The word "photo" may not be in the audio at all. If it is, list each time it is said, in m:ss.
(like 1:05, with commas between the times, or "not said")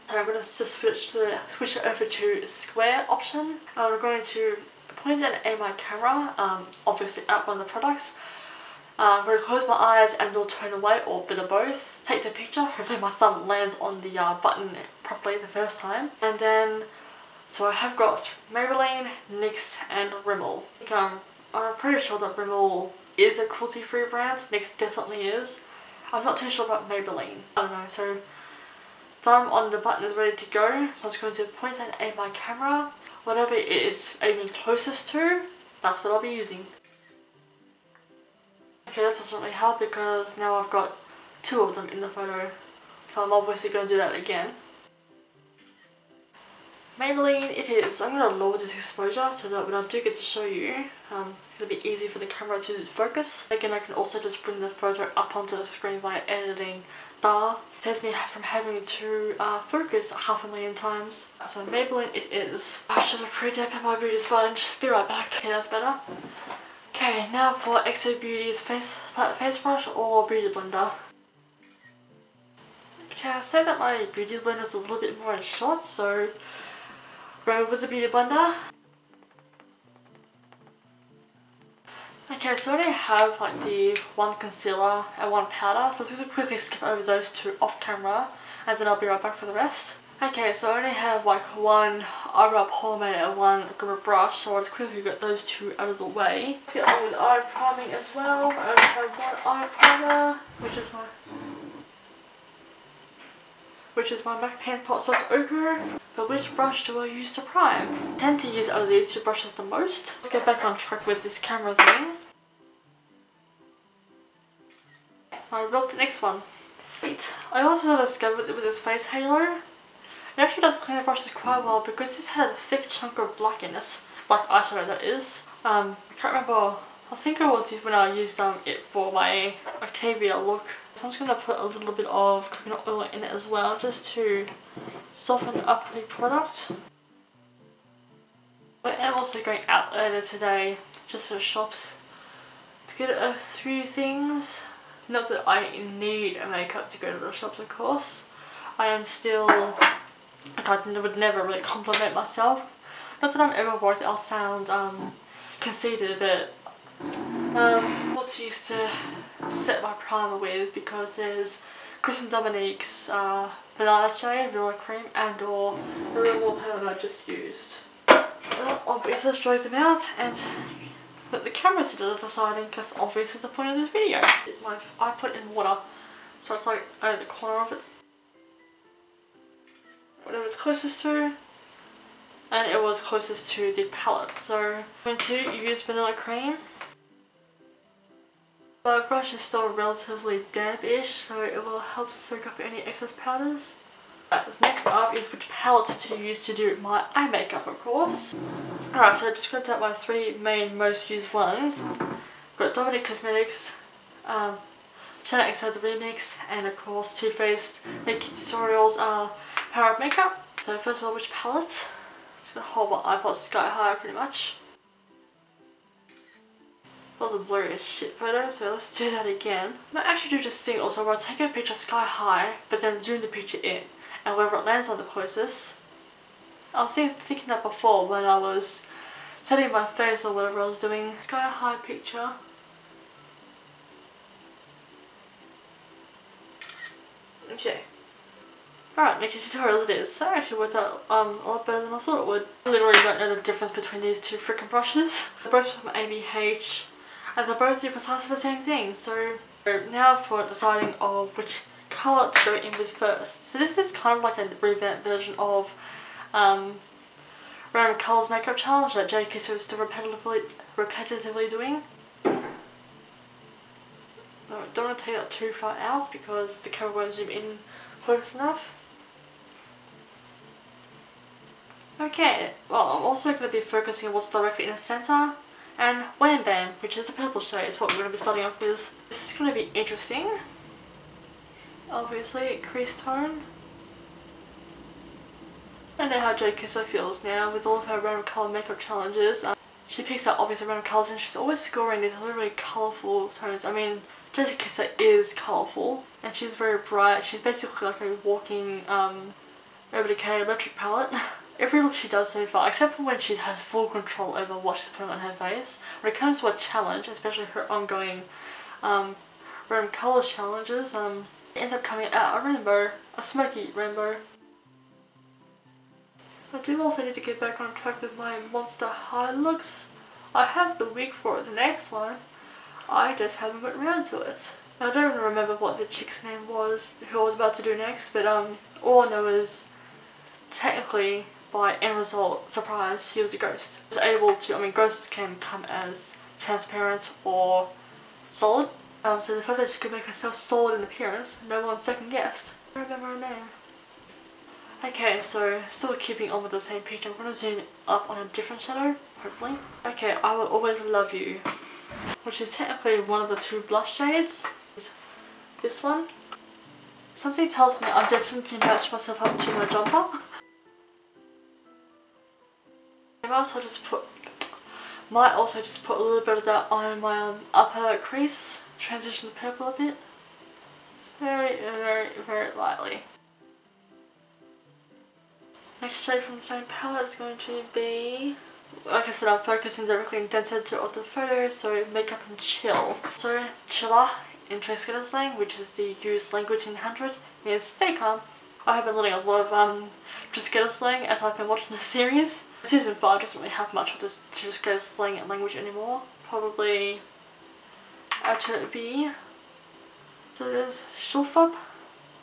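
0:42, 0:54, 3:38, 6:21.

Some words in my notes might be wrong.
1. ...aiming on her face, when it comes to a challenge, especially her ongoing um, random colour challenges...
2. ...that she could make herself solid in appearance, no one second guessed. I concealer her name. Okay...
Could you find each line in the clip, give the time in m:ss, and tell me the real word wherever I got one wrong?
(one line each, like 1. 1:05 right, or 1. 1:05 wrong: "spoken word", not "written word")
1. 5:04 wrong: "putting", not "aiming"
2. 5:39 wrong: "remember", not "concealer".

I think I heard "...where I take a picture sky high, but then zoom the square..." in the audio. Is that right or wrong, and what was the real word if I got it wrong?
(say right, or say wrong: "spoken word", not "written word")
wrong: "picture", not "square".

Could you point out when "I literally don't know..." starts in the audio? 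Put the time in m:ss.
4:02.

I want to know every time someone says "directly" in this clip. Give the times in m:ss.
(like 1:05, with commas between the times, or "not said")
4:34, 6:19.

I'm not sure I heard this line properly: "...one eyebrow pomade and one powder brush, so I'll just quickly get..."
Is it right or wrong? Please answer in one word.
wrong.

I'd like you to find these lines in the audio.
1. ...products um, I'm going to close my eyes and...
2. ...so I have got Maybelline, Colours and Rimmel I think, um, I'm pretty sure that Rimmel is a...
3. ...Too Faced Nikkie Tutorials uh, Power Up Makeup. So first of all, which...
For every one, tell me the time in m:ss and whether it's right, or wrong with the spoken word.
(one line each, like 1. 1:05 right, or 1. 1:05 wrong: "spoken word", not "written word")
1. 0:07 right
2. 0:17 wrong: "NYX", not "Colours"
3. 3:27 right.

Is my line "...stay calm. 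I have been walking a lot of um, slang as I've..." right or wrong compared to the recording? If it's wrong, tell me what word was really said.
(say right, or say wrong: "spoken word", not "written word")
wrong: "learning", not "walking".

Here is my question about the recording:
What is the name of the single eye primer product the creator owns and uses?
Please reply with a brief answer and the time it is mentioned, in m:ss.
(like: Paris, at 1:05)
MAC Paint Pot Soft Ochre, at 1:44.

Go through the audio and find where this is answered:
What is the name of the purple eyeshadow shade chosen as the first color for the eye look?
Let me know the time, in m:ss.
4:36.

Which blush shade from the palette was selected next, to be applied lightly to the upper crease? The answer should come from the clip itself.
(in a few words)
I Will Always Love You.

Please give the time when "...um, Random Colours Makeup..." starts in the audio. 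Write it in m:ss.
4:16.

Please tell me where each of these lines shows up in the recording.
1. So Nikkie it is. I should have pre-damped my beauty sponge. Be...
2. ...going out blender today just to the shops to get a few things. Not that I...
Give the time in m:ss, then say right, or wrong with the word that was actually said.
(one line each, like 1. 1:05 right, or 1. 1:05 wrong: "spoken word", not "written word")
1. 1:01 wrong: "Maybelline", not "Nikkie"
2. 2:19 wrong: "earlier", not "blender".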